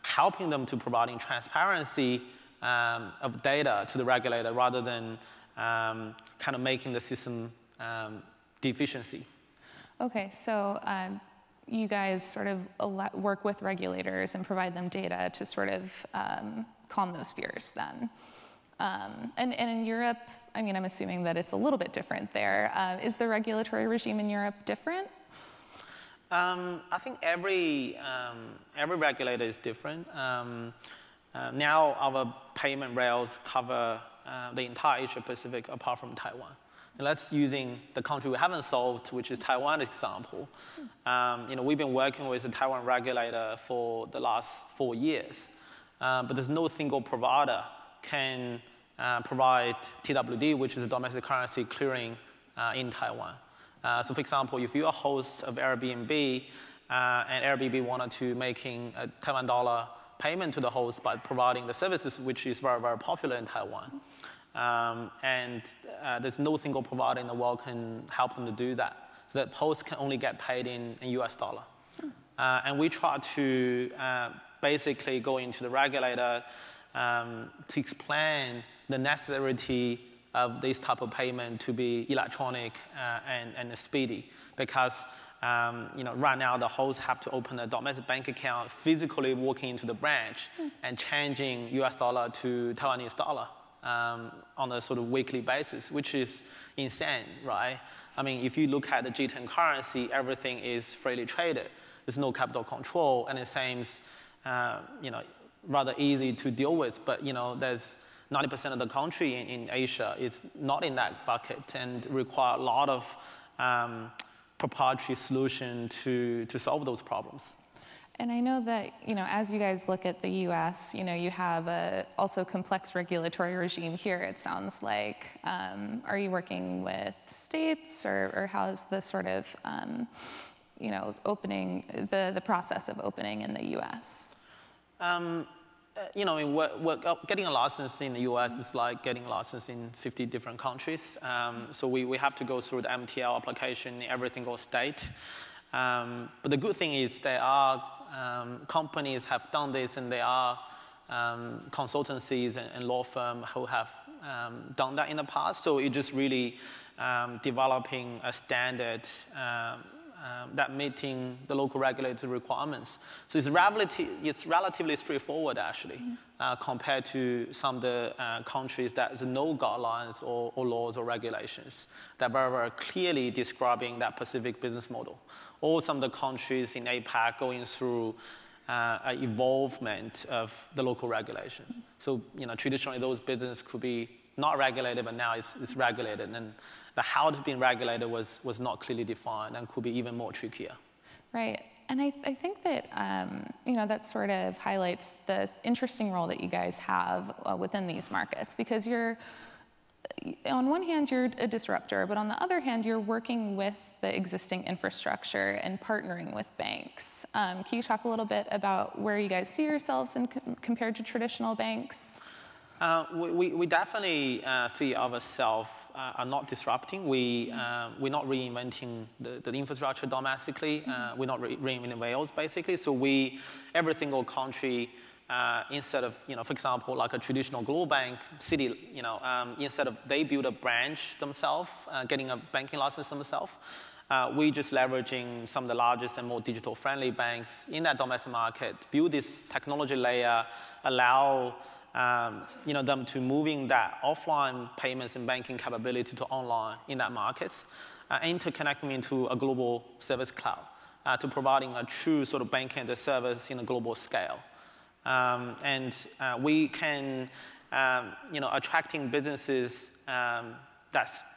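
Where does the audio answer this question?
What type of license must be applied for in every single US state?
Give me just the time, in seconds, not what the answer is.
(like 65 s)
142 s.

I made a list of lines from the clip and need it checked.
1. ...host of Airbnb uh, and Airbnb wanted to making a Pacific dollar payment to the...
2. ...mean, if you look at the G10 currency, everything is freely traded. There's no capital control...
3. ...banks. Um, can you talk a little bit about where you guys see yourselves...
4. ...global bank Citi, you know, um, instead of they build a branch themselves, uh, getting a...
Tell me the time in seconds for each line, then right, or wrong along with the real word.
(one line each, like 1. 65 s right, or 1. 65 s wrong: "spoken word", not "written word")
1. 54 s wrong: "Taiwan", not "Pacific"
2. 98 s right
3. 206 s right
4. 227 s right.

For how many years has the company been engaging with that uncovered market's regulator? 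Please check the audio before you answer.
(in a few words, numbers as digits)
4 years.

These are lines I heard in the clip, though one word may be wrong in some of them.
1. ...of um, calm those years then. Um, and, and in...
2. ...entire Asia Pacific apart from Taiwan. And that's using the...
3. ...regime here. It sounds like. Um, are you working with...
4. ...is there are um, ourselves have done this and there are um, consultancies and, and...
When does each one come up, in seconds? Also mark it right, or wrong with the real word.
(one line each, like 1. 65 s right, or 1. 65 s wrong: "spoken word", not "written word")
1. 15 s wrong: "fears", not "years"
2. 34 s right
3. 123 s right
4. 146 s wrong: "companies", not "ourselves".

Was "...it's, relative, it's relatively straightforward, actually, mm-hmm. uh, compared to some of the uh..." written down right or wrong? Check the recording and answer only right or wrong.
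right.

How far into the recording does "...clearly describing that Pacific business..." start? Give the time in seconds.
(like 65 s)
172 s.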